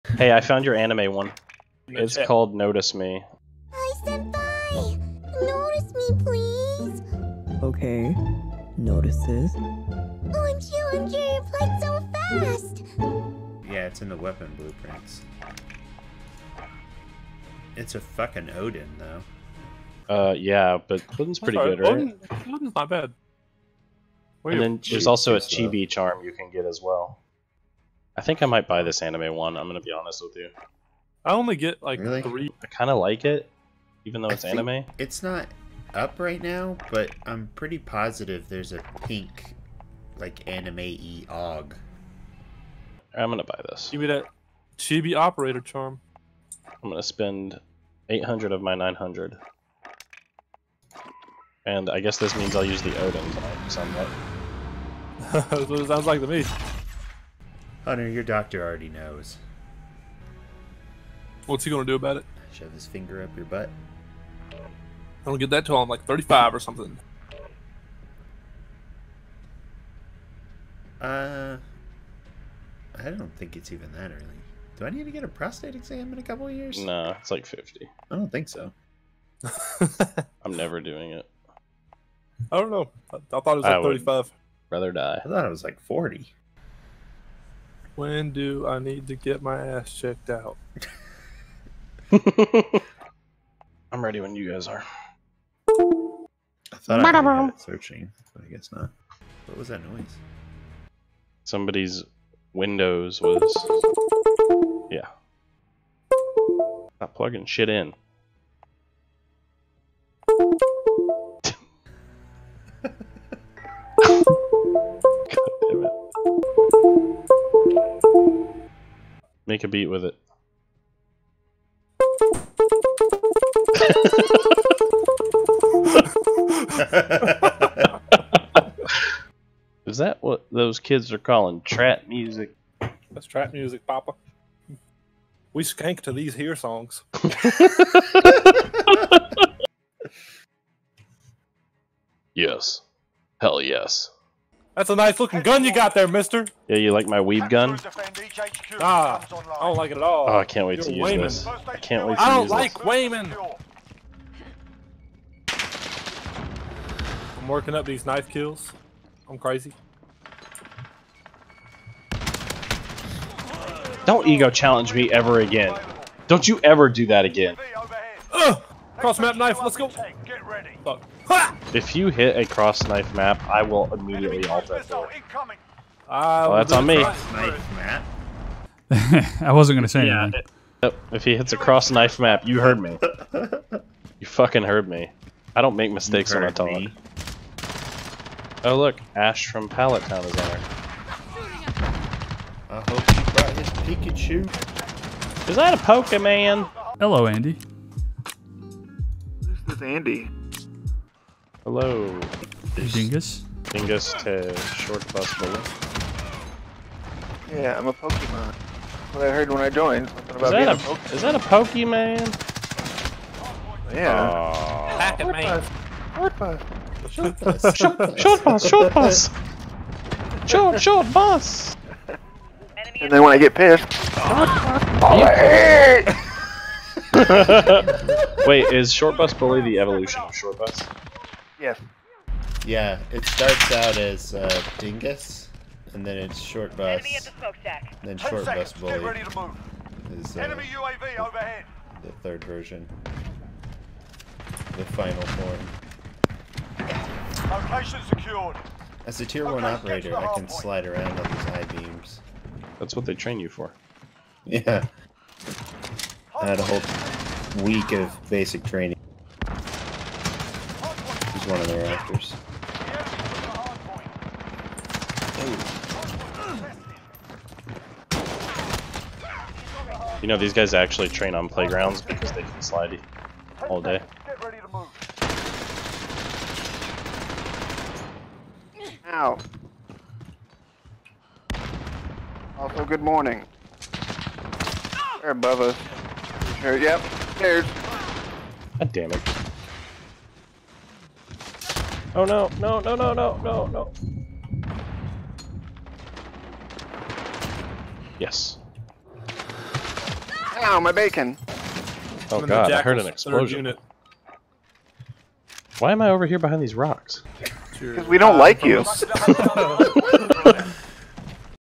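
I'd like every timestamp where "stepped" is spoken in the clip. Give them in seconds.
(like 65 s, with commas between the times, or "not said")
not said.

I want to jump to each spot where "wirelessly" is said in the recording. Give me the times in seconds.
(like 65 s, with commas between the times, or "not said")
not said.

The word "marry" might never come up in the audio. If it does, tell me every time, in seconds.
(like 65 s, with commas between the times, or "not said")
not said.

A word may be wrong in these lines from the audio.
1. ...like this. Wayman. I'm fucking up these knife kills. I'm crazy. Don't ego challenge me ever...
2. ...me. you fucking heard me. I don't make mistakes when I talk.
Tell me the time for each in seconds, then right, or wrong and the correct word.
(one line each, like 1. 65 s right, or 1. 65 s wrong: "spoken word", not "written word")
1. 152 s wrong: "working", not "fucking"
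2. 182 s right.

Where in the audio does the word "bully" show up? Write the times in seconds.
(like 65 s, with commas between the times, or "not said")
205 s, 229 s, 238 s.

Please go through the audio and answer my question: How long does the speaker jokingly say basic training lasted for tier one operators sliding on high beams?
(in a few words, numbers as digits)
a whole week.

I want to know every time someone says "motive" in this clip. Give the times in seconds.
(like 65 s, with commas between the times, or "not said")
not said.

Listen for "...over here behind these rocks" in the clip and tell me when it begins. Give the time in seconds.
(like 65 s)
306 s.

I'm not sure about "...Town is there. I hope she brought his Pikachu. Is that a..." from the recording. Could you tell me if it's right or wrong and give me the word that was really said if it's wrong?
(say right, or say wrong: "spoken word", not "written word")
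right.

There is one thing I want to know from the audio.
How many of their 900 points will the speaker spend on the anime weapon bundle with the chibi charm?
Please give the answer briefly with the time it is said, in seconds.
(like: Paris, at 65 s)
800, at 48 s.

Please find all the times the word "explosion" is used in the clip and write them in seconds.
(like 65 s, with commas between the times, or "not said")
303 s.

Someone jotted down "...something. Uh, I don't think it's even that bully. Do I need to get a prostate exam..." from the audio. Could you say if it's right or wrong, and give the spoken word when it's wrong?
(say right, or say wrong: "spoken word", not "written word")
wrong: "early", not "bully".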